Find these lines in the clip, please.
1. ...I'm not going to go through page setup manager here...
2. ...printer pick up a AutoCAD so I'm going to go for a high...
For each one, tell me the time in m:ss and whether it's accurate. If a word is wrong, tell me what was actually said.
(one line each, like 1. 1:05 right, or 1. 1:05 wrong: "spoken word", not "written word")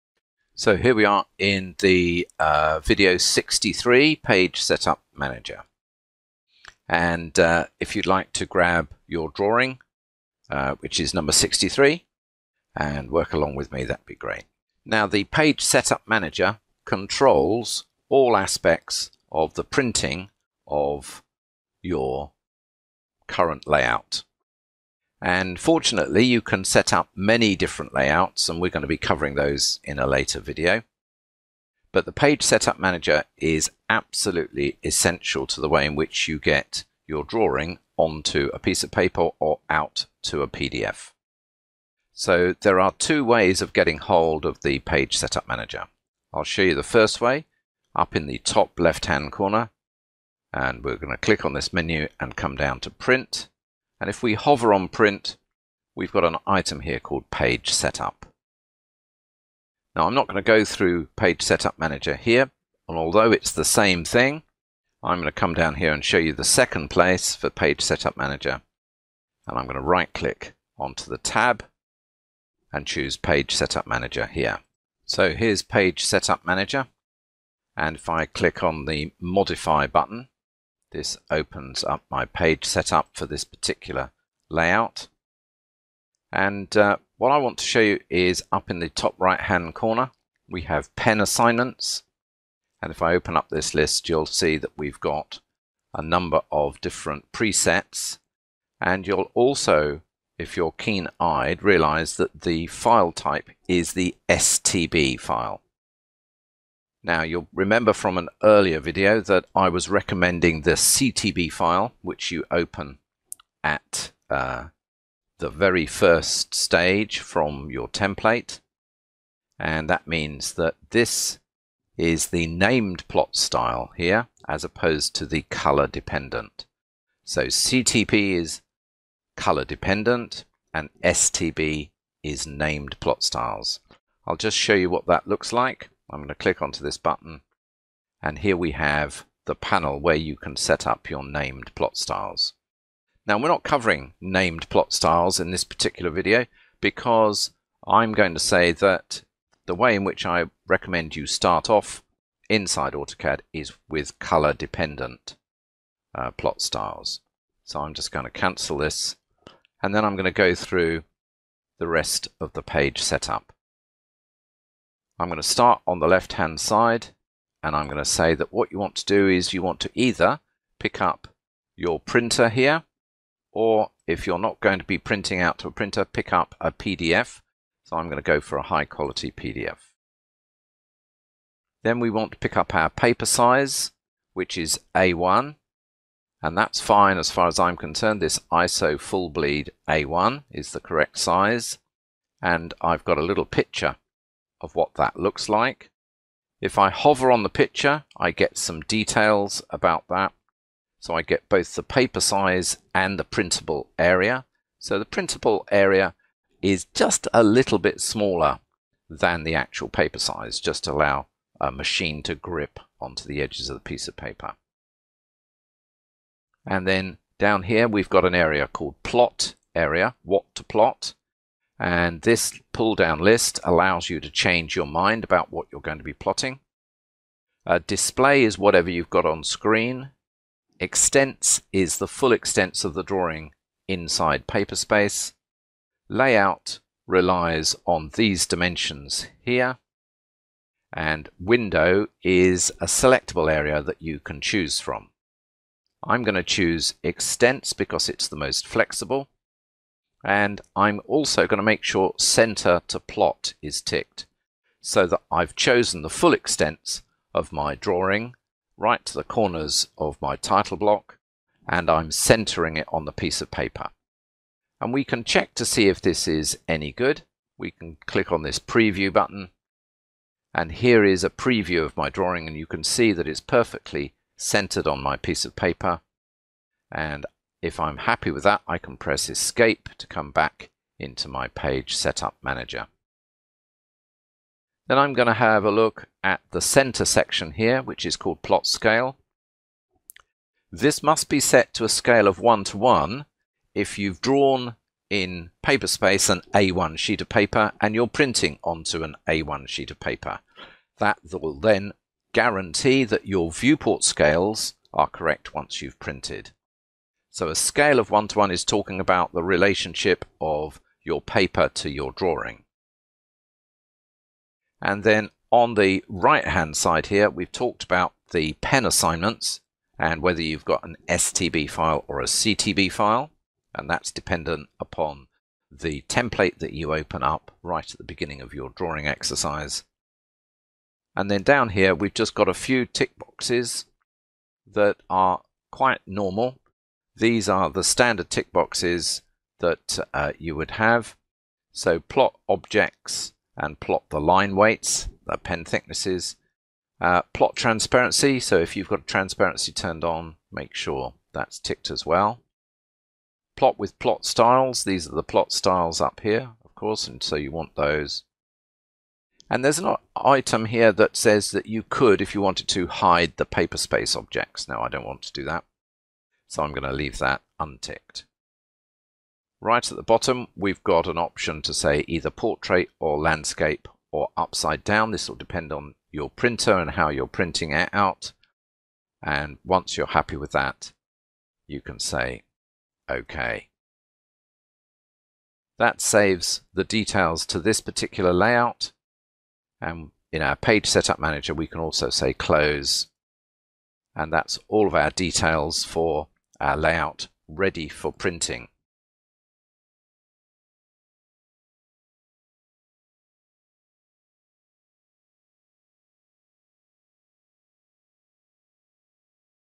1. 1:00 right
2. 2:55 wrong: "PDF", not "AutoCAD".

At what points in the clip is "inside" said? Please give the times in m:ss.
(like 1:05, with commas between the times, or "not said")
2:32, 3:53.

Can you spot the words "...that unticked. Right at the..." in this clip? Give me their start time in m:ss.
6:07.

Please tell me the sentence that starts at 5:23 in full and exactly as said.
And that's dependent upon the template that you open up right at the beginning of your drawing exercise.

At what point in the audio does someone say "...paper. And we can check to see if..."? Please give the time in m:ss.
4:23.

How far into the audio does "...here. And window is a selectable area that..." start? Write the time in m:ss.
3:59.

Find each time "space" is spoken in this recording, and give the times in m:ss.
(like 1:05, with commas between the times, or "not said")
3:54, 4:55, 6:03.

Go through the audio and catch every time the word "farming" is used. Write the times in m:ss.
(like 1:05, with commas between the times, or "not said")
not said.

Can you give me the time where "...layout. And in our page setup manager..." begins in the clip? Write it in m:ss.
6:28.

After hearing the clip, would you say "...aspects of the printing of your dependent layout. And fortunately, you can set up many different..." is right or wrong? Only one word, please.
wrong.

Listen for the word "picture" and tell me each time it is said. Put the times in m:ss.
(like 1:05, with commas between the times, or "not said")
3:13, 3:17.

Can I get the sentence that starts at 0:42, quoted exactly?
So there are two ways of getting hold of the Page Setup Manager.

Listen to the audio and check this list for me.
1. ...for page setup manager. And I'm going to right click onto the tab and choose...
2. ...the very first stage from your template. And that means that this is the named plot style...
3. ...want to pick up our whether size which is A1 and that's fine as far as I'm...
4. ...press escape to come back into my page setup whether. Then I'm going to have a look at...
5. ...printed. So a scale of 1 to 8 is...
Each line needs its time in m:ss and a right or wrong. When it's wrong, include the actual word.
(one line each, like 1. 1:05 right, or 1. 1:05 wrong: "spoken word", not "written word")
1. 1:07 right
2. 1:55 right
3. 3:02 wrong: "paper", not "whether"
4. 4:38 wrong: "manager", not "whether"
5. 5:05 wrong: "1", not "8".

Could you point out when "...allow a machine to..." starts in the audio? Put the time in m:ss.
3:30.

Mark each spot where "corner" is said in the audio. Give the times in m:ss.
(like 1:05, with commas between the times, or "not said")
0:49, 1:29, 4:19.